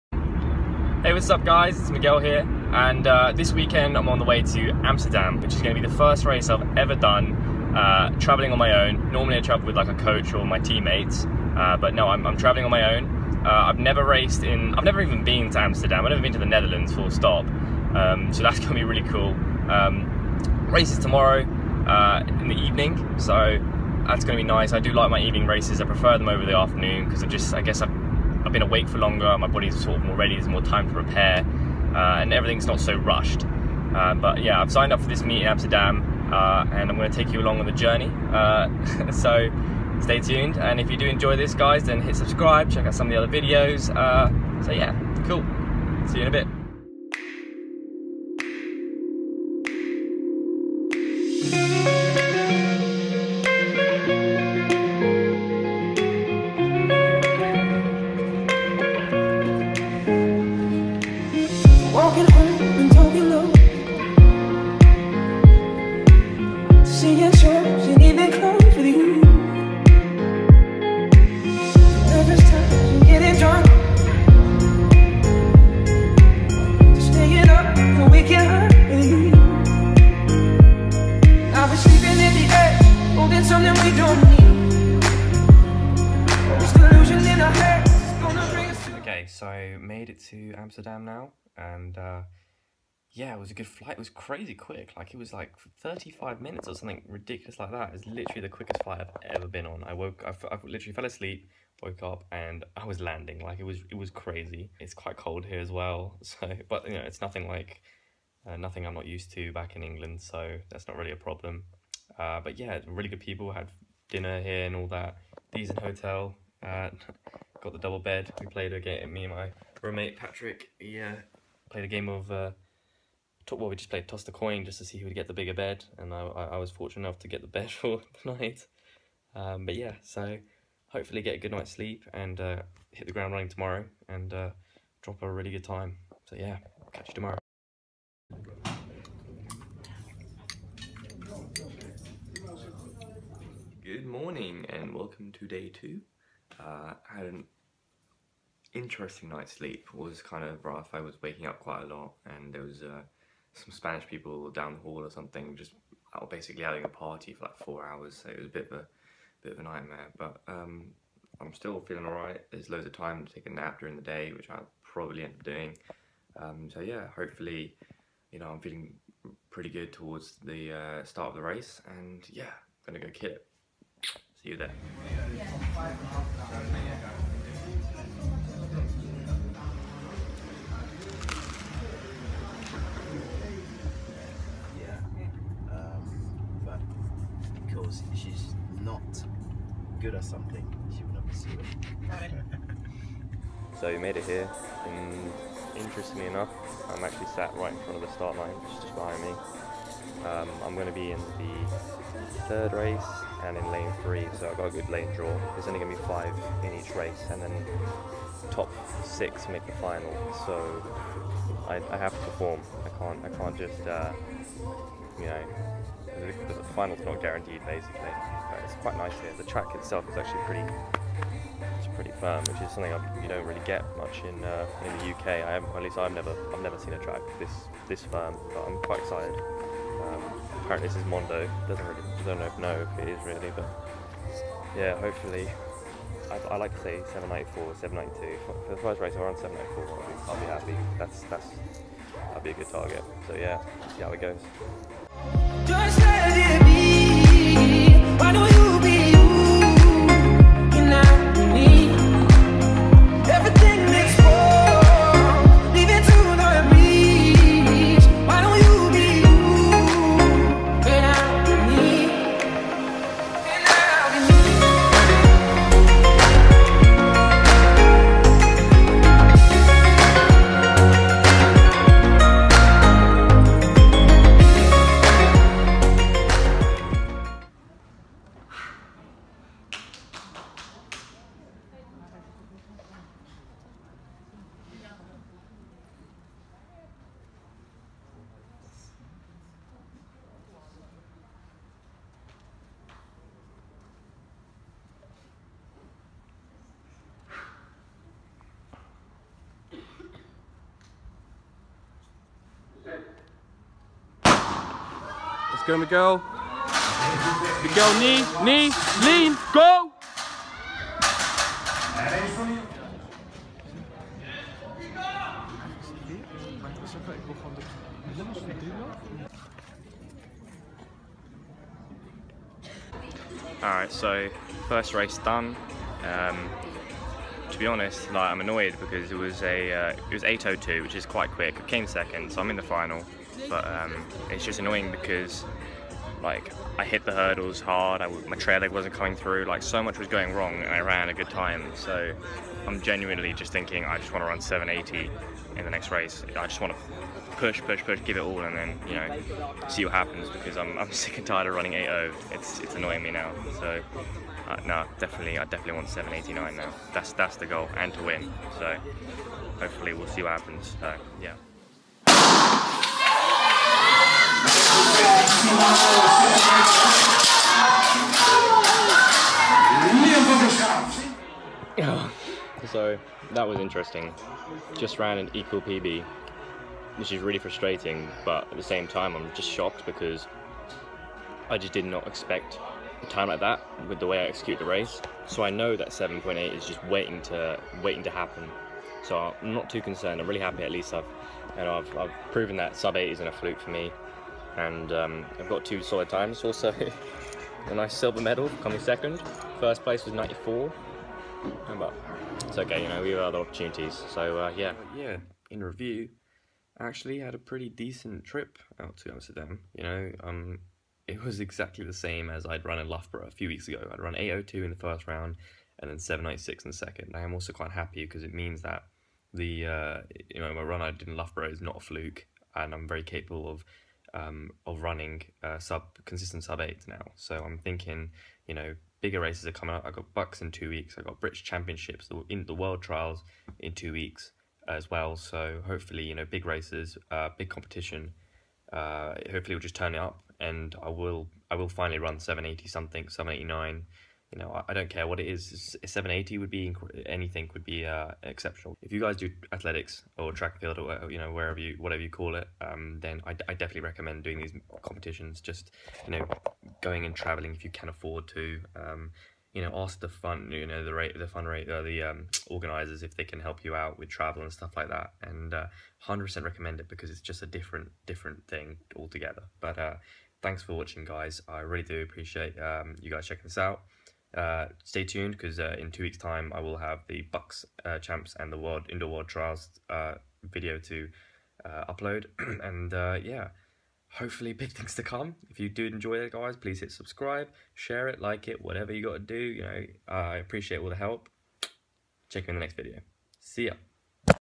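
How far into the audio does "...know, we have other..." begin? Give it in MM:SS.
06:42.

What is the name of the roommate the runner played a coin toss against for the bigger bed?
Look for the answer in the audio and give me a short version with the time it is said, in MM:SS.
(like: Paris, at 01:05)
Patrick, at 02:00.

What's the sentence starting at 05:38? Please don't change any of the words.
I, my trail leg wasn't coming through.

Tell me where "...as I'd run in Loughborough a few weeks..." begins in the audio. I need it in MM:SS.
06:52.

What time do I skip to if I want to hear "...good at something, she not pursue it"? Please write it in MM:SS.
03:09.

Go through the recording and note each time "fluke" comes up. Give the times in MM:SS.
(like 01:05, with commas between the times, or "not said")
06:33, 07:01.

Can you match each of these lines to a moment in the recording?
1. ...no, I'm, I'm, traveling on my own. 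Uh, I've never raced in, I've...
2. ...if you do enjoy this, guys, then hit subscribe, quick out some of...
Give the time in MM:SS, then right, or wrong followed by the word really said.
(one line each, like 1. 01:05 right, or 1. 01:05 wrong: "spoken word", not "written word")
1. 00:11 right
2. 00:40 wrong: "check", not "quick".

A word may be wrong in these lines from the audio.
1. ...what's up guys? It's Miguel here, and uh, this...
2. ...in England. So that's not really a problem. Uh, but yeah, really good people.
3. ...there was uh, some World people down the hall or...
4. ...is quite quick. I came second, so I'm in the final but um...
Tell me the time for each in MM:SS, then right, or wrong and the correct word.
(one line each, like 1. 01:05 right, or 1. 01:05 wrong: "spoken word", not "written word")
1. 00:01 right
2. 01:49 right
3. 02:32 wrong: "Spanish", not "World"
4. 05:30 right.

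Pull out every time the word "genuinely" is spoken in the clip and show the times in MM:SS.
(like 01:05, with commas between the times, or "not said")
05:42.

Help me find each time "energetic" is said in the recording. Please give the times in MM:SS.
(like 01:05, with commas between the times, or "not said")
not said.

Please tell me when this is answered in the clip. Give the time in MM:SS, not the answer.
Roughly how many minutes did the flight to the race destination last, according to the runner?
01:35.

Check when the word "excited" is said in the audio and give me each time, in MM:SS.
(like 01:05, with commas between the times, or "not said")
03:48.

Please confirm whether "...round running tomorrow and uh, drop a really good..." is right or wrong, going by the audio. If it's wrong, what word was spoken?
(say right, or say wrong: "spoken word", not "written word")
wrong: "ground", not "round".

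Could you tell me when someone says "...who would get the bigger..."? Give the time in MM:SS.
02:04.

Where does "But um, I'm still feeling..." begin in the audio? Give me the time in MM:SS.
02:40.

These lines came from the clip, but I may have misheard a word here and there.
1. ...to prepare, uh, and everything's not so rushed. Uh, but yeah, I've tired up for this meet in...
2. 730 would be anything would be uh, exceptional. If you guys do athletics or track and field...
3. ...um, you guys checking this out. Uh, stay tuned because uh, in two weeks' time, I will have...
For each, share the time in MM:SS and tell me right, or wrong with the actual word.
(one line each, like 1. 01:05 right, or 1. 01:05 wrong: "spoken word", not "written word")
1. 00:30 wrong: "signed", not "tired"
2. 07:25 wrong: "780", not "730"
3. 07:52 right.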